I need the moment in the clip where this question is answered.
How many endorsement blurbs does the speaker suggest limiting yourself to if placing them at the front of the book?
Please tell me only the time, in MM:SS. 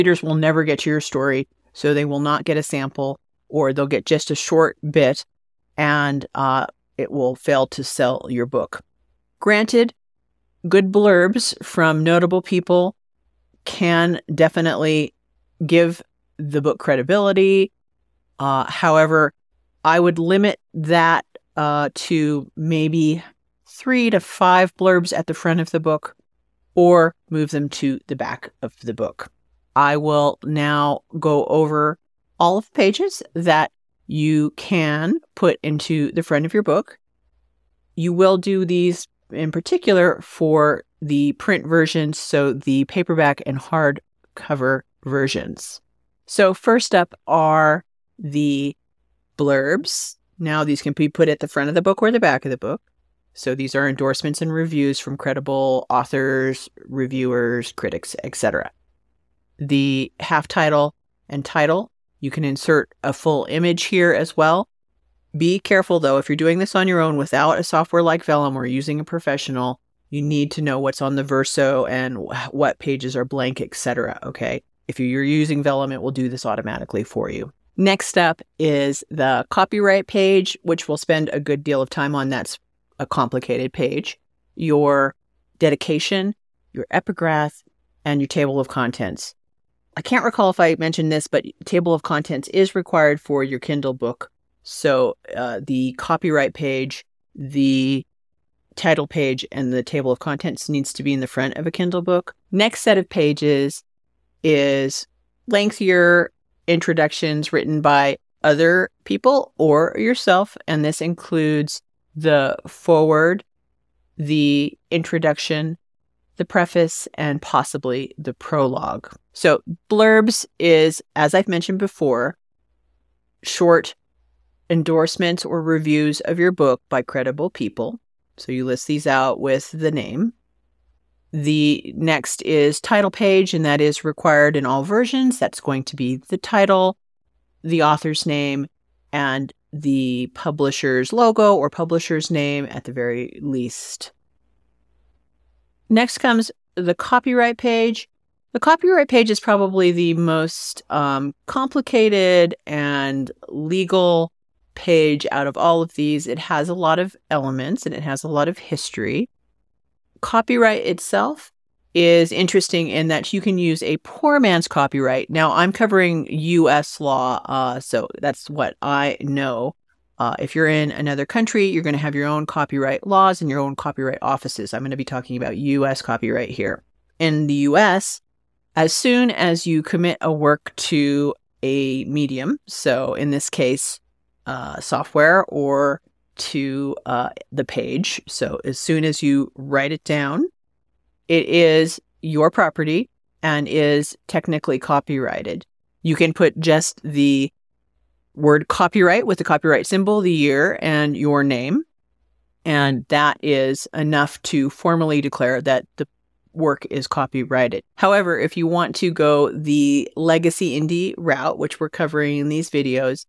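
00:23.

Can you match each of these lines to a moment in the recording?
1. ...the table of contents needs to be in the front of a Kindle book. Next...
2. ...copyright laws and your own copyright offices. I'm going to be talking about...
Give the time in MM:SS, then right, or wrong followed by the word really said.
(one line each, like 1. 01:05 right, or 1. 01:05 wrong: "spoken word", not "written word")
1. 01:39 right
2. 02:52 right.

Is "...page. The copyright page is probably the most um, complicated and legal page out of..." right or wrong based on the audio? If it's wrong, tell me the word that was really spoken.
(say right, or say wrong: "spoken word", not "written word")
right.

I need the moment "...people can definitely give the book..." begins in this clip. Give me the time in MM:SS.
00:12.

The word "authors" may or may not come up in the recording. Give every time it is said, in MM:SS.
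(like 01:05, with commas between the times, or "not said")
00:55, 02:17.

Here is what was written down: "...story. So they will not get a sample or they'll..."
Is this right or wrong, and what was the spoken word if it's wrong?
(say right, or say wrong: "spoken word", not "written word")
right.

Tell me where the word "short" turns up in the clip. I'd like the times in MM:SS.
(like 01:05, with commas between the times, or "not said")
00:04, 02:03.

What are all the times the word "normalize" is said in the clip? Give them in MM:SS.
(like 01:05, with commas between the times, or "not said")
not said.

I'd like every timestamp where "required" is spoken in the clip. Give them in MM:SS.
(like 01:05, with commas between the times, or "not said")
01:32, 02:14.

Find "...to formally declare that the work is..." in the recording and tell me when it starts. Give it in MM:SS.
03:24.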